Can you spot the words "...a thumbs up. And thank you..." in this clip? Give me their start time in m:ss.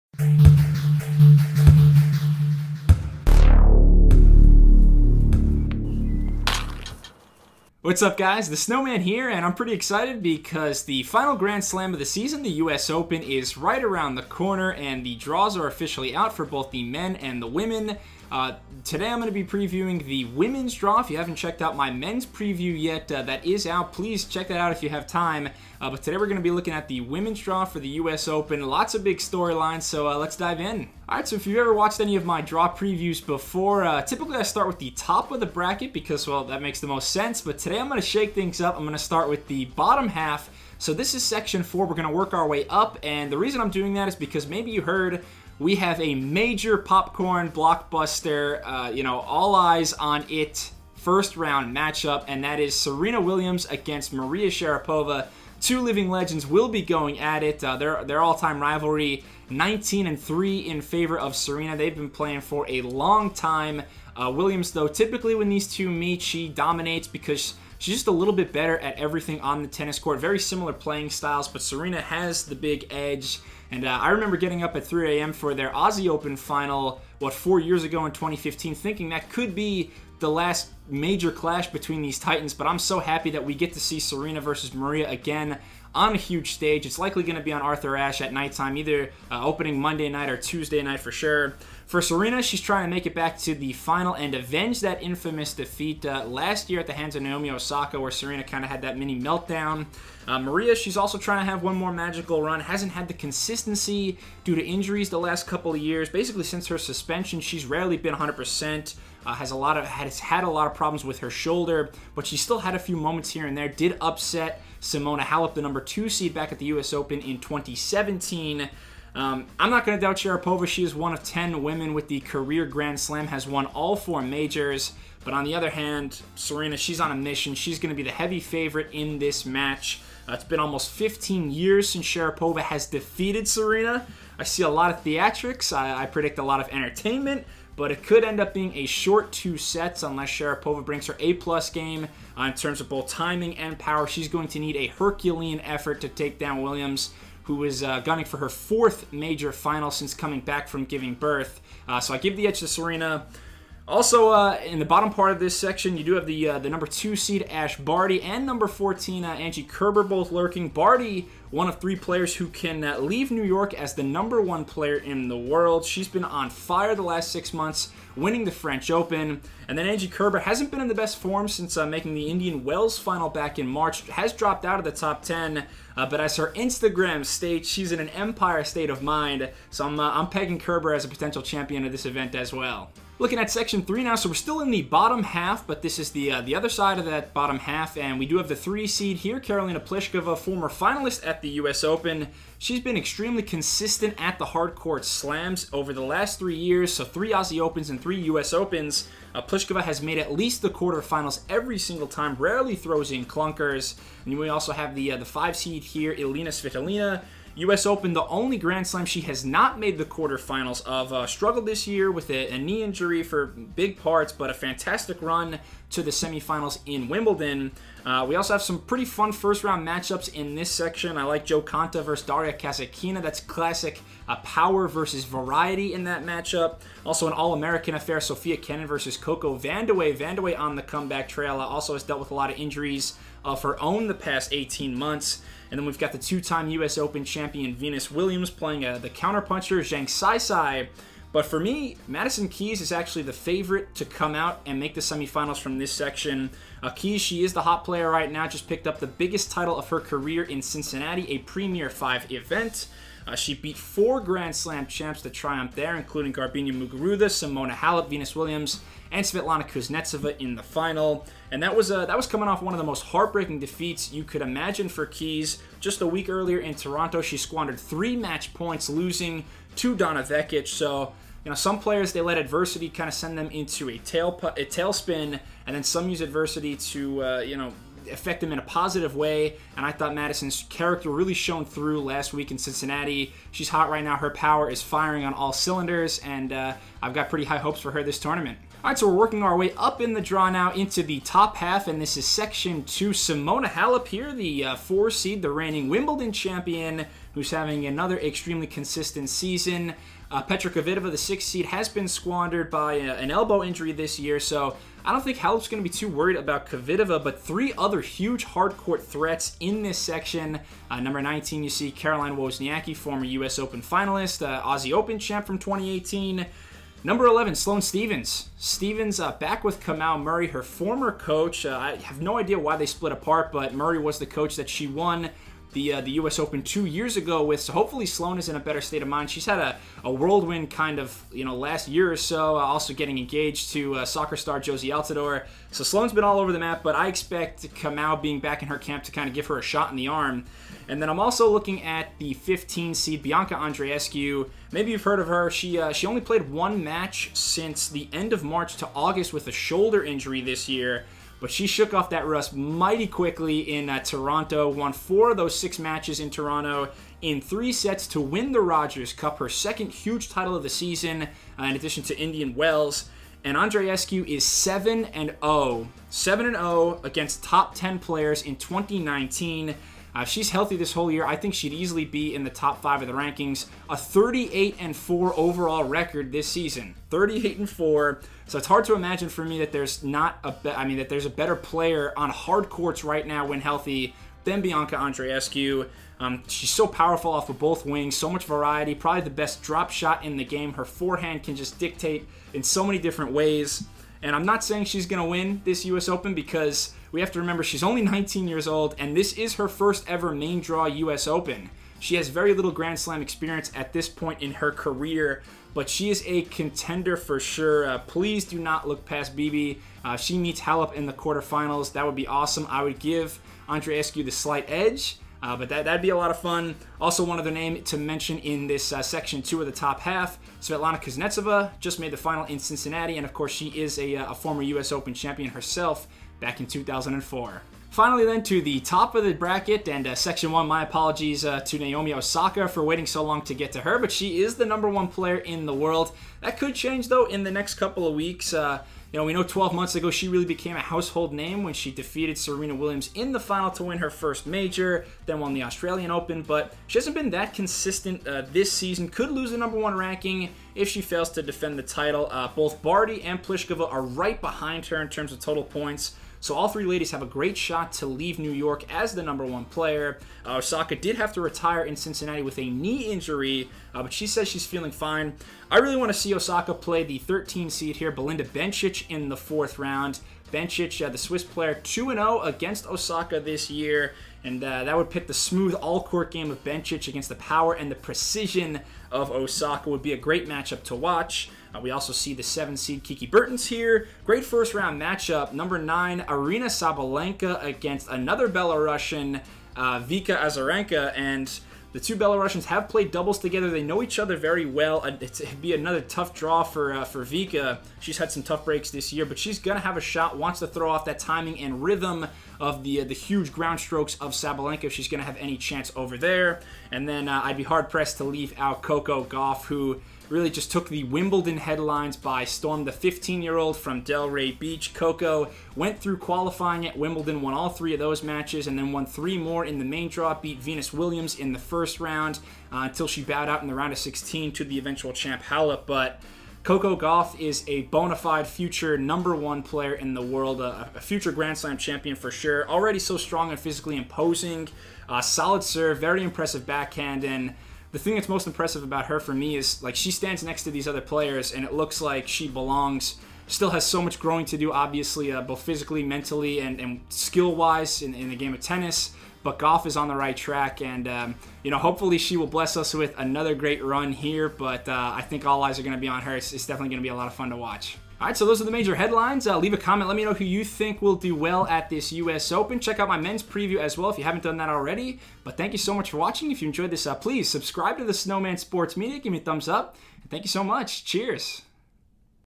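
9:29.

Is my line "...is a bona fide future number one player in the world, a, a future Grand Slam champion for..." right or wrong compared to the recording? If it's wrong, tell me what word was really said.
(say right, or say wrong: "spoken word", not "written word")
right.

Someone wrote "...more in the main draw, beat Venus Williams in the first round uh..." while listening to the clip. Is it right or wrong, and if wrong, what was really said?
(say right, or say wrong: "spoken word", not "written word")
right.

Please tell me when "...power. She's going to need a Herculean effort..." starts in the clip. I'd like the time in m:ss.
2:23.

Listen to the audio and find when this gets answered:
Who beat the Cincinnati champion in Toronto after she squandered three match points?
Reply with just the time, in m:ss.
4:29.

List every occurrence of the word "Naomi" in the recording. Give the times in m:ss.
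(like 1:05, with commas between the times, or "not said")
1:37, 7:11.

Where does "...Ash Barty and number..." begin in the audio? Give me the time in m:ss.
2:37.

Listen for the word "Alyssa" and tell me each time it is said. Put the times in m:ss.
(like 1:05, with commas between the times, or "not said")
not said.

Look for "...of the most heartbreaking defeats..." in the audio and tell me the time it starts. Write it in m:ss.
4:22.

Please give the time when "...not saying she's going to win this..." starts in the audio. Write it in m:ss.
6:34.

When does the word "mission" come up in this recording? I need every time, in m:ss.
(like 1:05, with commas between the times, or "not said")
2:07.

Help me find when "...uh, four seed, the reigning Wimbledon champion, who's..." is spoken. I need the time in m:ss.
4:54.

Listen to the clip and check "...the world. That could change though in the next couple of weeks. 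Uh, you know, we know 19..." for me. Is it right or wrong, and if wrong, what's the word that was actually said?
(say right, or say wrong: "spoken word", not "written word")
wrong: "12", not "19".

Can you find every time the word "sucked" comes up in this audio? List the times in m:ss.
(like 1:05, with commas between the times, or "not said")
not said.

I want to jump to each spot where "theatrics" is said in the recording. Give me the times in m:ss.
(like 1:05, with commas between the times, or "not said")
2:15.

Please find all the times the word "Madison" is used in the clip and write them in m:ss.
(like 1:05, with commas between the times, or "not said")
4:02, 4:40.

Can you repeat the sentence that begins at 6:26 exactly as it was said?
Um, she's so powerful off of both wings, so much variety, probably the best drop shot in the game.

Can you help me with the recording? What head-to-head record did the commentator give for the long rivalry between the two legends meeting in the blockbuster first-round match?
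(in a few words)
19 and 3.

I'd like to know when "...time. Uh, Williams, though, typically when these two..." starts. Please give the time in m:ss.
1:03.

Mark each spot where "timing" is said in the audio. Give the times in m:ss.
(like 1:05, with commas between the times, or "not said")
2:23, 8:21.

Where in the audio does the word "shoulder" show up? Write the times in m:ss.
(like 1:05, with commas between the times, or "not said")
1:51, 5:49.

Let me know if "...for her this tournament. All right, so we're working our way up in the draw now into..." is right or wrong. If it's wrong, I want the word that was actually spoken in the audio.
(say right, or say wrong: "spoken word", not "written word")
right.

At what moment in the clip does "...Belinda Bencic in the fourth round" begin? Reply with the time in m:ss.
7:48.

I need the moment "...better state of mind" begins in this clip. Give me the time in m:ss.
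5:28.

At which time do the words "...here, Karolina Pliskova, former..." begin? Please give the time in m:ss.
3:09.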